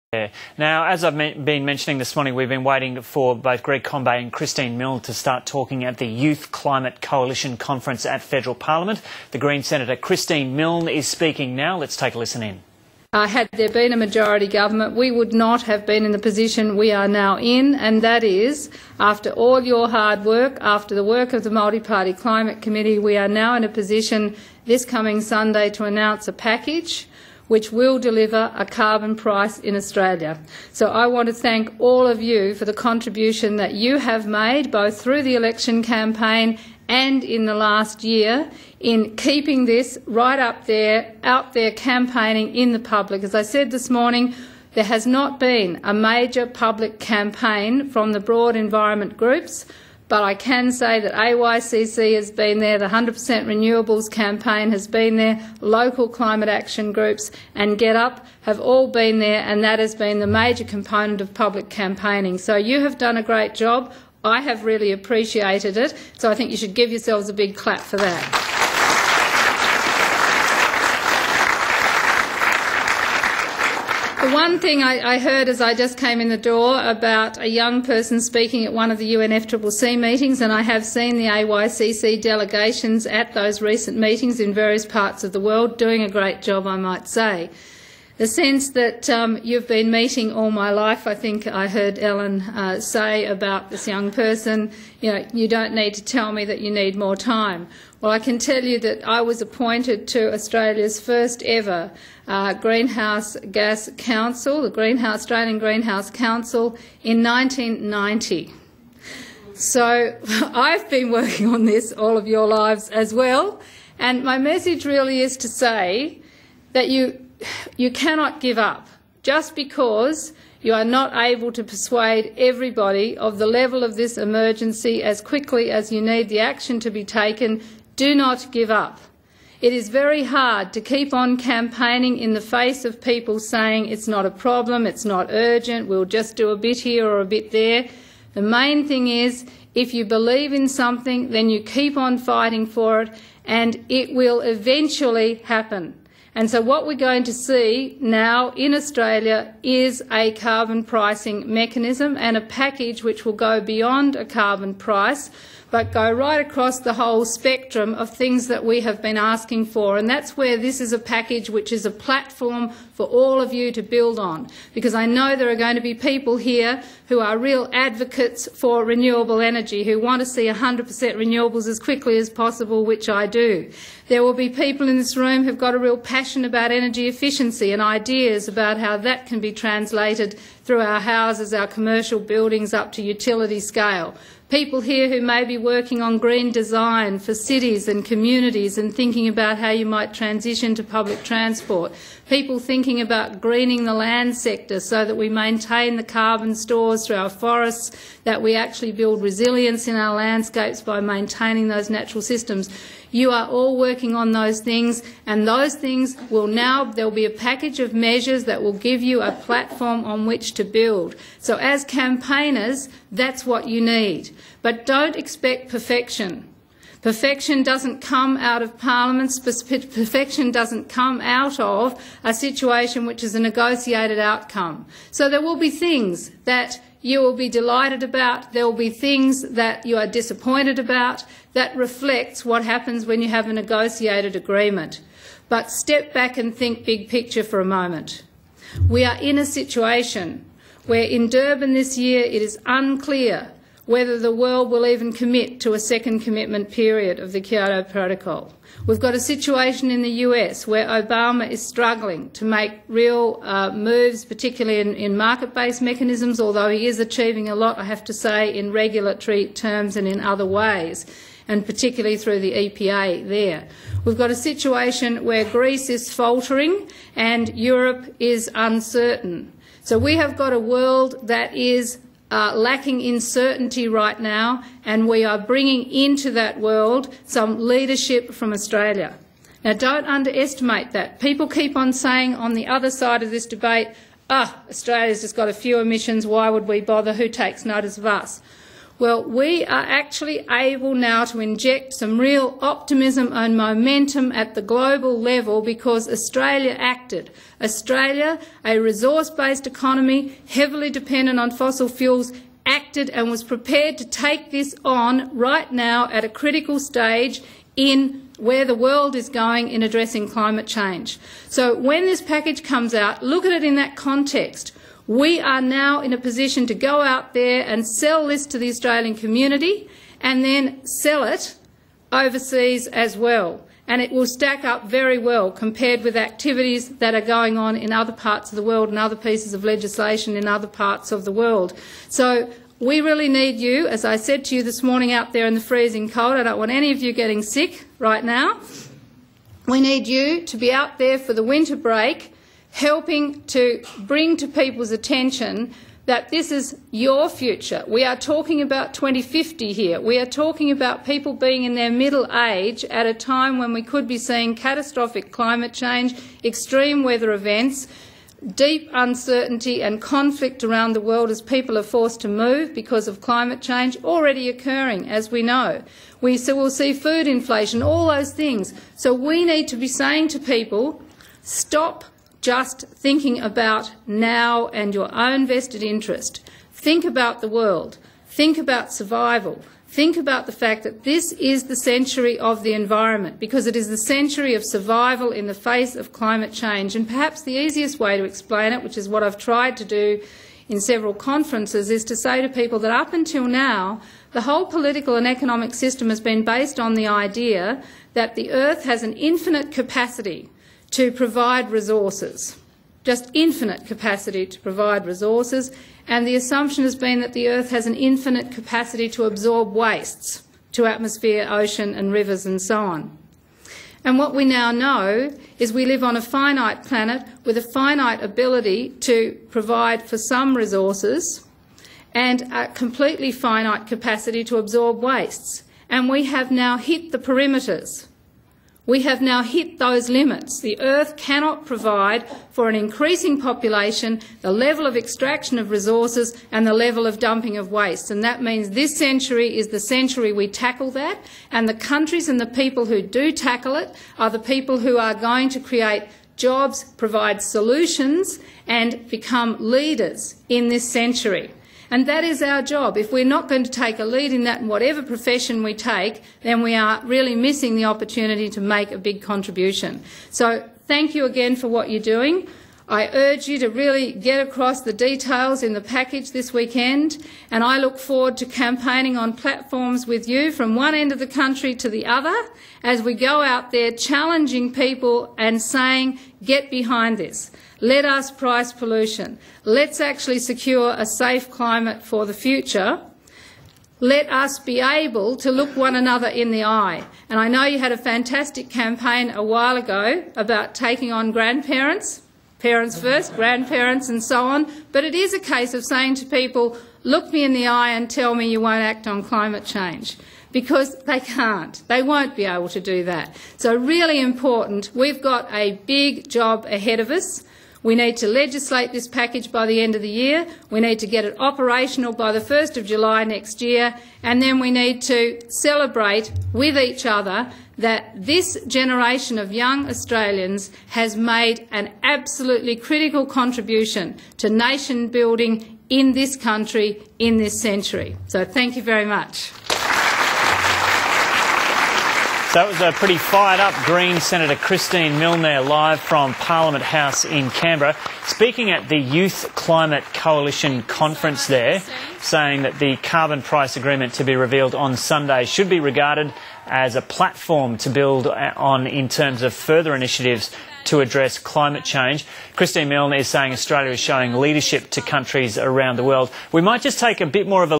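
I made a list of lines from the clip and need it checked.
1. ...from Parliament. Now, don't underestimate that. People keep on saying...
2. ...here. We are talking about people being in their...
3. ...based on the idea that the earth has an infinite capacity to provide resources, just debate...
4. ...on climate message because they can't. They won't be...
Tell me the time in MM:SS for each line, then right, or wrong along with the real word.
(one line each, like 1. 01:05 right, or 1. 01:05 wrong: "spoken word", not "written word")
1. 04:38 wrong: "Australia", not "Parliament"
2. 05:49 right
3. 06:36 wrong: "infinite", not "debate"
4. 08:19 wrong: "change", not "message".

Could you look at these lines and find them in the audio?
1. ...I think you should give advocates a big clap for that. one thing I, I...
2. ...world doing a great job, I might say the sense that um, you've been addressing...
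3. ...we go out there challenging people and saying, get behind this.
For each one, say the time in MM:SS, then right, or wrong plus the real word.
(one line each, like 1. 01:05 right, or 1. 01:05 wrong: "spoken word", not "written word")
1. 01:06 wrong: "yourselves", not "advocates"
2. 01:25 wrong: "meeting", not "addressing"
3. 07:53 right.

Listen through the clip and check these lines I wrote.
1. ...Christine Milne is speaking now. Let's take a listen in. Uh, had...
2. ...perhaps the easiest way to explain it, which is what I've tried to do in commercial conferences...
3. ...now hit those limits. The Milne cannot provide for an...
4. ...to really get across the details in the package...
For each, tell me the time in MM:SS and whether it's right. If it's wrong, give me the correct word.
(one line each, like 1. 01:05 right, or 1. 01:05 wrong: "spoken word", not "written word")
1. 00:09 right
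2. 06:27 wrong: "several", not "commercial"
3. 07:09 wrong: "Earth", not "Milne"
4. 07:43 right.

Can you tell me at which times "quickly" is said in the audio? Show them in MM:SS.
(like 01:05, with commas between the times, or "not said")
02:05, 02:51.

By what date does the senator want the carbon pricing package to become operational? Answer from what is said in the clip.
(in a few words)
1 July next year.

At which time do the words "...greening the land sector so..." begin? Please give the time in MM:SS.
03:13.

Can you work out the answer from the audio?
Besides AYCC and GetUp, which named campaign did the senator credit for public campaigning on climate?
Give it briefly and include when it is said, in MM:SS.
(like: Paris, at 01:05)
100% Renewables, at 00:52.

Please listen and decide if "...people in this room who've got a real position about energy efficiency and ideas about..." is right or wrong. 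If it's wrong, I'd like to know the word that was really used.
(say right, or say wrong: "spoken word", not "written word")
wrong: "passion", not "position".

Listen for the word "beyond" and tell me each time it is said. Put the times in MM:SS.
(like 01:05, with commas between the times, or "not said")
02:33.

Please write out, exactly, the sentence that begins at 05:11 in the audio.
So when this package comes out, look at it in that context.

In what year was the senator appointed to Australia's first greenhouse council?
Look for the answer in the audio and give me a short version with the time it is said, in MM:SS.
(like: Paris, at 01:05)
1990, at 01:47.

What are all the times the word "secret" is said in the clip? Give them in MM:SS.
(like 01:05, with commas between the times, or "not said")
not said.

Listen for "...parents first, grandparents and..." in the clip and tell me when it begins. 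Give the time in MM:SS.
08:12.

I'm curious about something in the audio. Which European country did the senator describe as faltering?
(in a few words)
Greece.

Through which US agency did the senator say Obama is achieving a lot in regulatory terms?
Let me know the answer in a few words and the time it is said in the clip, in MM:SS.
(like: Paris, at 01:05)
EPA, at 04:22.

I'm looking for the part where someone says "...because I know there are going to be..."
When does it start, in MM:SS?
02:44.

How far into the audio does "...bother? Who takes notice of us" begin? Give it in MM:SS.
04:46.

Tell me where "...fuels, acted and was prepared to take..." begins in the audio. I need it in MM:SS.
05:01.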